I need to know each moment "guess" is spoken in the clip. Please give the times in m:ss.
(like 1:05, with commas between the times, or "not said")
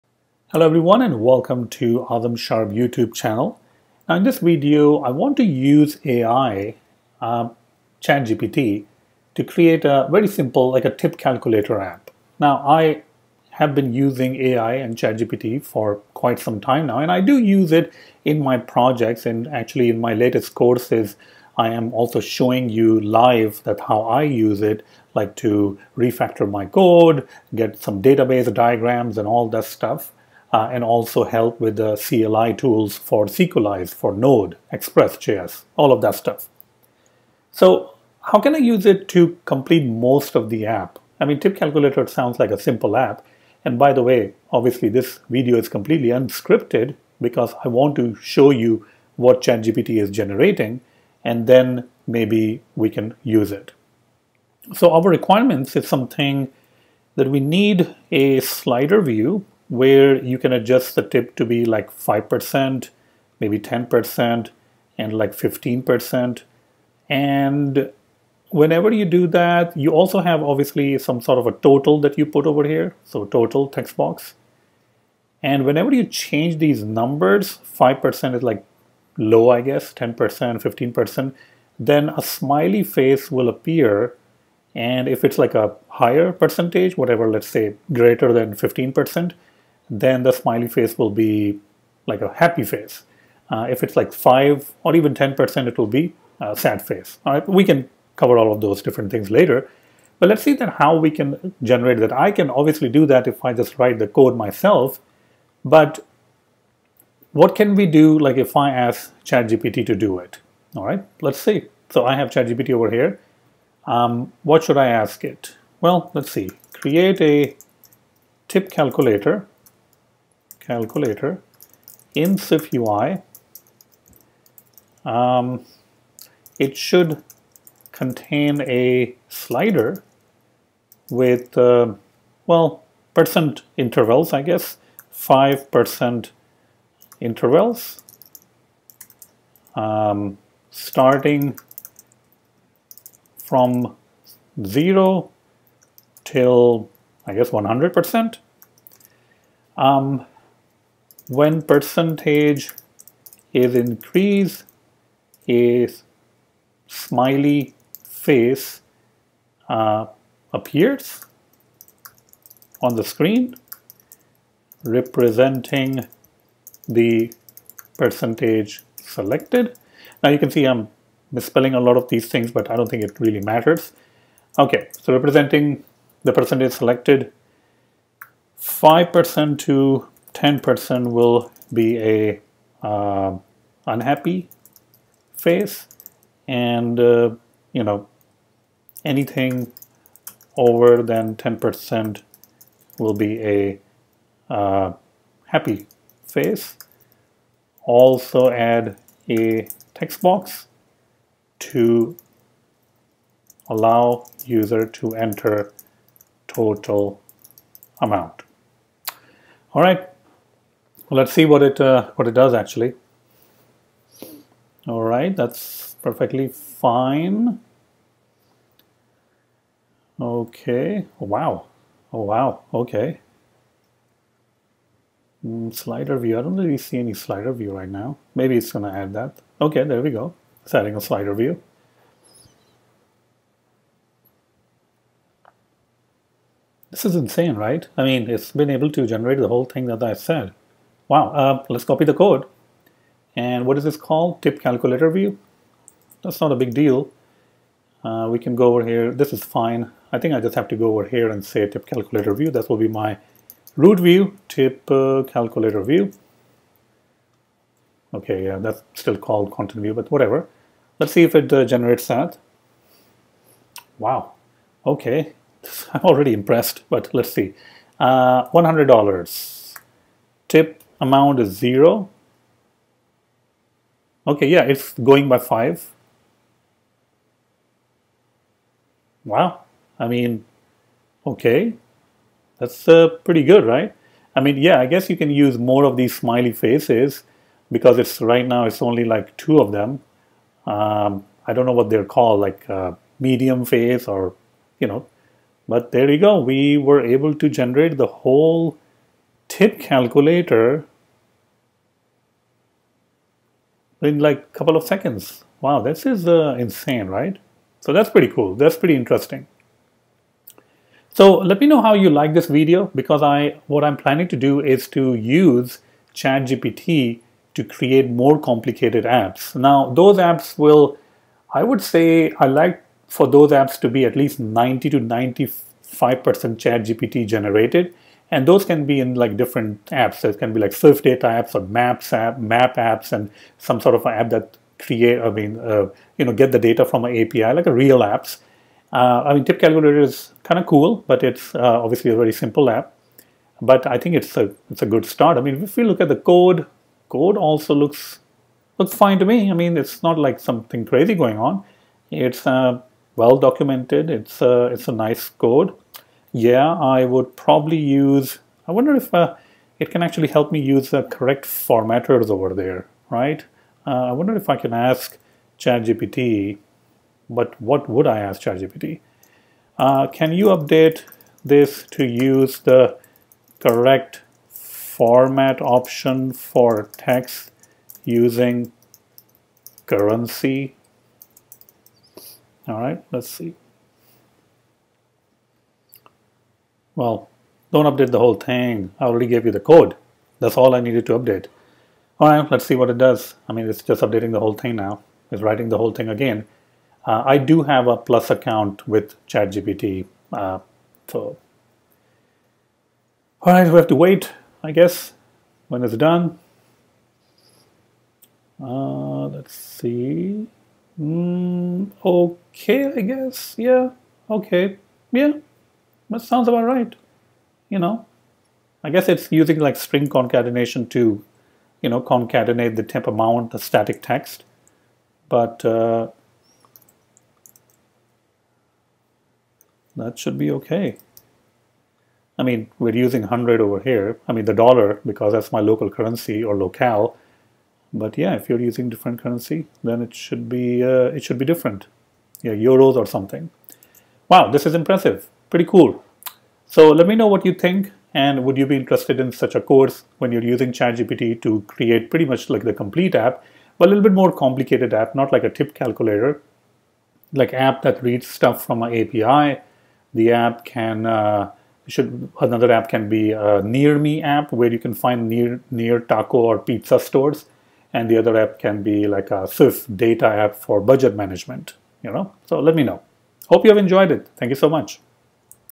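1:19, 2:14, 2:27, 4:44, 6:44, 6:53, 6:58.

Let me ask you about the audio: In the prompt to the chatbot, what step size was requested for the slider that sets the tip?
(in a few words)
5%.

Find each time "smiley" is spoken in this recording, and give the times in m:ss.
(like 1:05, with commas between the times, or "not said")
1:22, 1:30, 2:36, 4:46.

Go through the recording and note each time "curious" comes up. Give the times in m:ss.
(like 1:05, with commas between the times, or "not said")
not said.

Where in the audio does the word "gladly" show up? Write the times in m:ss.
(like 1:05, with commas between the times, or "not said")
not said.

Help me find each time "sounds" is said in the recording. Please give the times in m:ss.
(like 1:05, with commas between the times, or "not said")
0:42, 6:56.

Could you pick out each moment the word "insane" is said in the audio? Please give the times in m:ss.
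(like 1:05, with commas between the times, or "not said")
3:57, 5:06.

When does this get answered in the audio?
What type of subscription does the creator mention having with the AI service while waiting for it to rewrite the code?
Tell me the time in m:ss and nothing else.
6:37.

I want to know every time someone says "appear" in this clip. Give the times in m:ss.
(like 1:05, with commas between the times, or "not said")
1:23, 2:40.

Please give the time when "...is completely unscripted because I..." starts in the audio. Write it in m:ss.
0:45.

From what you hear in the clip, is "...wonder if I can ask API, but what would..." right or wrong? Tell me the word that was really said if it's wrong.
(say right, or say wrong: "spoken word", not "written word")
wrong: "ChatGPT", not "API".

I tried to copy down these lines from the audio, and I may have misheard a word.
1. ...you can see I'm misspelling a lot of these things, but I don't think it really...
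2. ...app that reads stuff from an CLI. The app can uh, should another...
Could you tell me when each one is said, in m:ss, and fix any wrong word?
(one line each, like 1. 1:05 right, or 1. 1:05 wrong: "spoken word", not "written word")
1. 2:50 right
2. 7:37 wrong: "API", not "CLI".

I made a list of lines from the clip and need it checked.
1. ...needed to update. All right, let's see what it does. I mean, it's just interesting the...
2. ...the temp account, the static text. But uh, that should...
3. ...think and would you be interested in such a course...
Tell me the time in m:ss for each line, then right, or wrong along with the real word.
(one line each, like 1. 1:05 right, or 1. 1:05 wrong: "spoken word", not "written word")
1. 6:30 wrong: "updating", not "interesting"
2. 7:02 wrong: "amount", not "account"
3. 7:27 right.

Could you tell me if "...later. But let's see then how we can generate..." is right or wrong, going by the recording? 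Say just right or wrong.
right.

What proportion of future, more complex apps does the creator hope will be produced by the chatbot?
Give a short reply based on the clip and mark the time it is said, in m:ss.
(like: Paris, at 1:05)
90 to 95%, at 5:24.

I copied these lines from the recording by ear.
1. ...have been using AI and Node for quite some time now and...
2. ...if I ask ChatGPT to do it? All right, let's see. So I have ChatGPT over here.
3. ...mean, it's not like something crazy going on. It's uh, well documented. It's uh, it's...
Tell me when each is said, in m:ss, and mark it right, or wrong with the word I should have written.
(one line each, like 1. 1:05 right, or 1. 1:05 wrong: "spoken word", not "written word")
1. 0:13 wrong: "ChatGPT", not "Node"
2. 1:48 right
3. 5:49 right.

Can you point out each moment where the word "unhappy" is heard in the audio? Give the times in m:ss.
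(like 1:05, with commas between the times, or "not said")
3:03.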